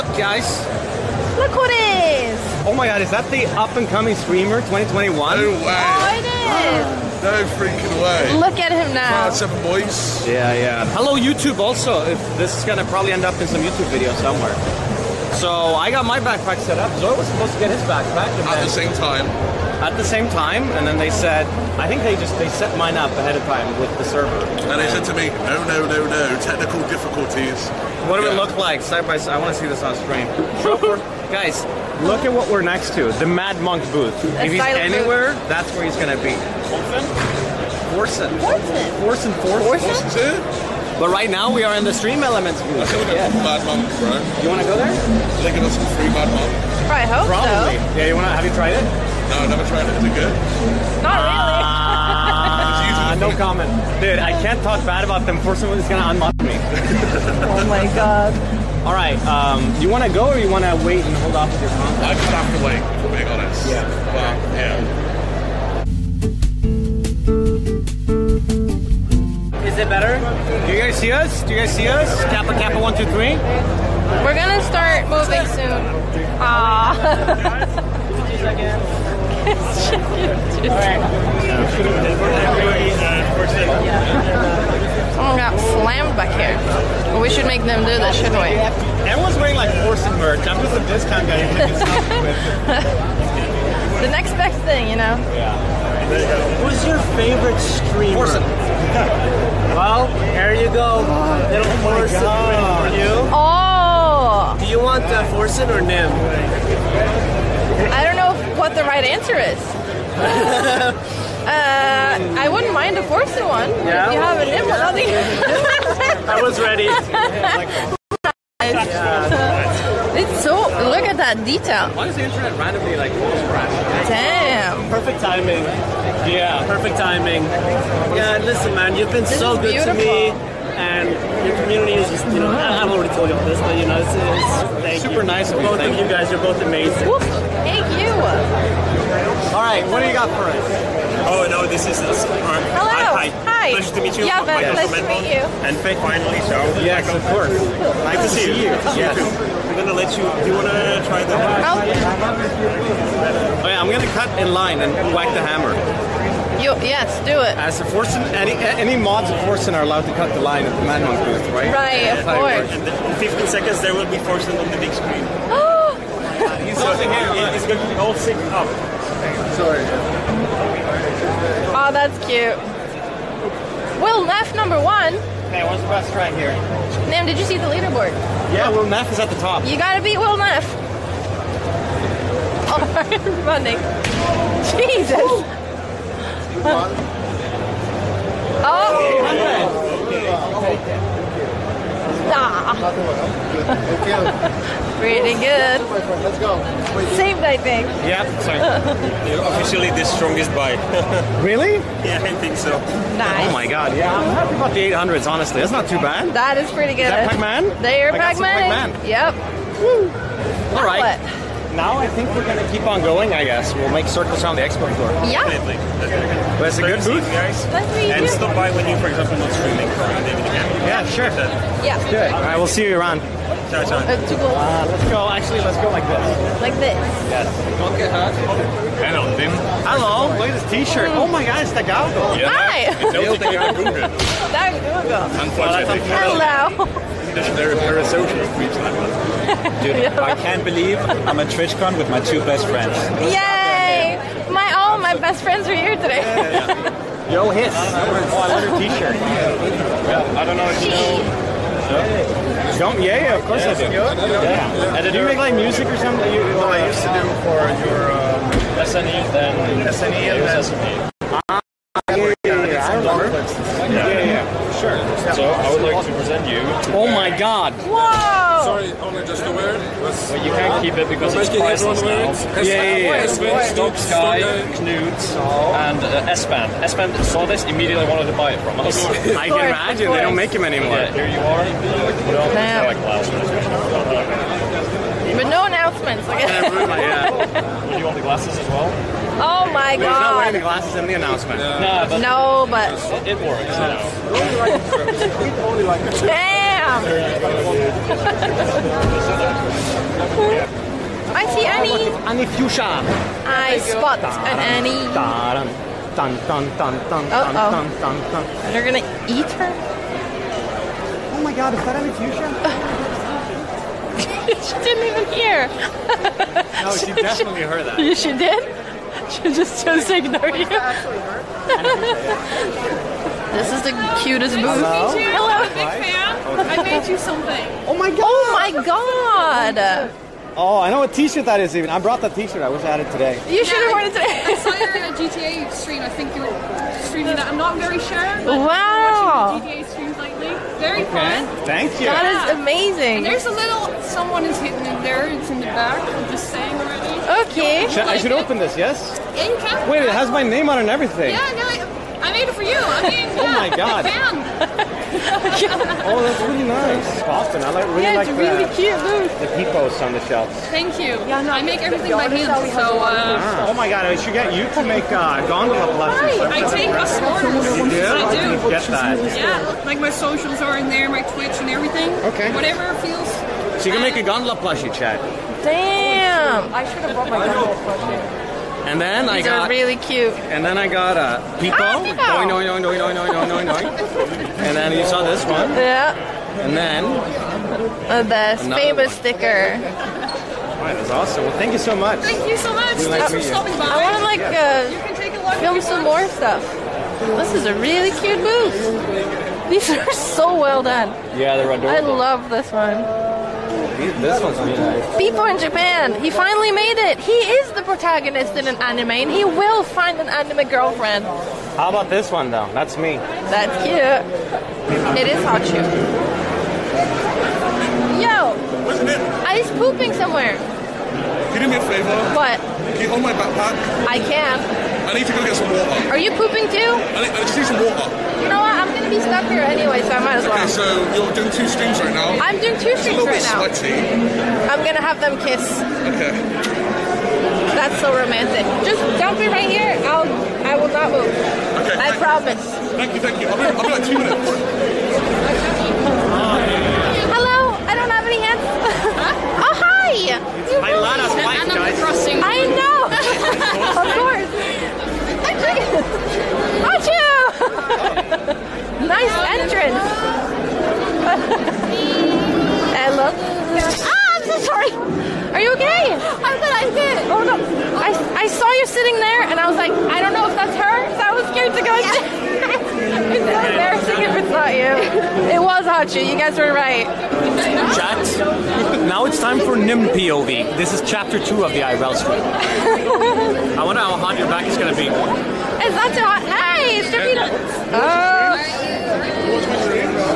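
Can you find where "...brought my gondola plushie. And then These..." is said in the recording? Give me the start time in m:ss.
6:17.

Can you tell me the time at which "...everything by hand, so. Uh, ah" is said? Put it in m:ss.
6:01.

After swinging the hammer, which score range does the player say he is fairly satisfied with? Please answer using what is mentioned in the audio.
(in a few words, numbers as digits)
800s.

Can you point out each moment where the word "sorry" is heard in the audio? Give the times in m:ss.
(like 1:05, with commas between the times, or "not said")
2:49, 3:18.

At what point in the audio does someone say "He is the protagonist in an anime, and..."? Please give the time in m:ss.
6:47.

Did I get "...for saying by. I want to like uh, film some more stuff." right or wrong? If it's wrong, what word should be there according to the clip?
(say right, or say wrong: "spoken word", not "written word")
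wrong: "stopping", not "saying".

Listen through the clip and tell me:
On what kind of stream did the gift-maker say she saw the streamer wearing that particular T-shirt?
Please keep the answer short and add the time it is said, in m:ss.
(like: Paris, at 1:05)
GTA stream, at 5:35.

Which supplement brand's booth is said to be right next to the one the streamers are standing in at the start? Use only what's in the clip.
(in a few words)
Madmonq.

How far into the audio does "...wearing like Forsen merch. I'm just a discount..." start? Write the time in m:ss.
1:29.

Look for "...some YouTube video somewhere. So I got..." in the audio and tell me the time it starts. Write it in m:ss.
0:13.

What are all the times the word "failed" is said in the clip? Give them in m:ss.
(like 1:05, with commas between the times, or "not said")
not said.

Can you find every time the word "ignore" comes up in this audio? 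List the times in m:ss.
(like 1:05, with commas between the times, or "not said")
5:20.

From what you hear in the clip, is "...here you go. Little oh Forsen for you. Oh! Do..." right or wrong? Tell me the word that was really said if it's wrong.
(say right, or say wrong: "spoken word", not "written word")
right.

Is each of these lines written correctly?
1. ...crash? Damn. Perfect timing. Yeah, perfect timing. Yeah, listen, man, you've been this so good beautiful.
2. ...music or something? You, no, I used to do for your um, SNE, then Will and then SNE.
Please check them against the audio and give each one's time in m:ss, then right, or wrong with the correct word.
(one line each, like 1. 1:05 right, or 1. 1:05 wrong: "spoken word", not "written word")
1. 2:03 right
2. 4:15 wrong: "SNE", not "Will".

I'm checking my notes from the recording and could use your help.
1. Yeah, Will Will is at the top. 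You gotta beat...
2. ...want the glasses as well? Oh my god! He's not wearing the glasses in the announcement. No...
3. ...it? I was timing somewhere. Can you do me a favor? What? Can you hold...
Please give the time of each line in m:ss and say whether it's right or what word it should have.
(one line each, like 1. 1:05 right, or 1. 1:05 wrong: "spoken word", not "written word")
1. 2:58 wrong: "Neff", not "Will"
2. 4:48 right
3. 6:59 wrong: "pooping", not "timing".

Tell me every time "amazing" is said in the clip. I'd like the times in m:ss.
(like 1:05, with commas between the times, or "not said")
2:16, 5:42.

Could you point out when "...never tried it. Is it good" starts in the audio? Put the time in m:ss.
0:49.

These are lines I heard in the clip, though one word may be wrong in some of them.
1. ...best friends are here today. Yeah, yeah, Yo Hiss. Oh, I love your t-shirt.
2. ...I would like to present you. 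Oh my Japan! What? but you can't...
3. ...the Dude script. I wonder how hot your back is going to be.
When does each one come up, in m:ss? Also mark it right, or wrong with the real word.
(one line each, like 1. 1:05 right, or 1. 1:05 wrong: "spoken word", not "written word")
1. 4:05 right
2. 4:25 wrong: "God", not "Japan"
3. 8:01 wrong: "IRL", not "Dude".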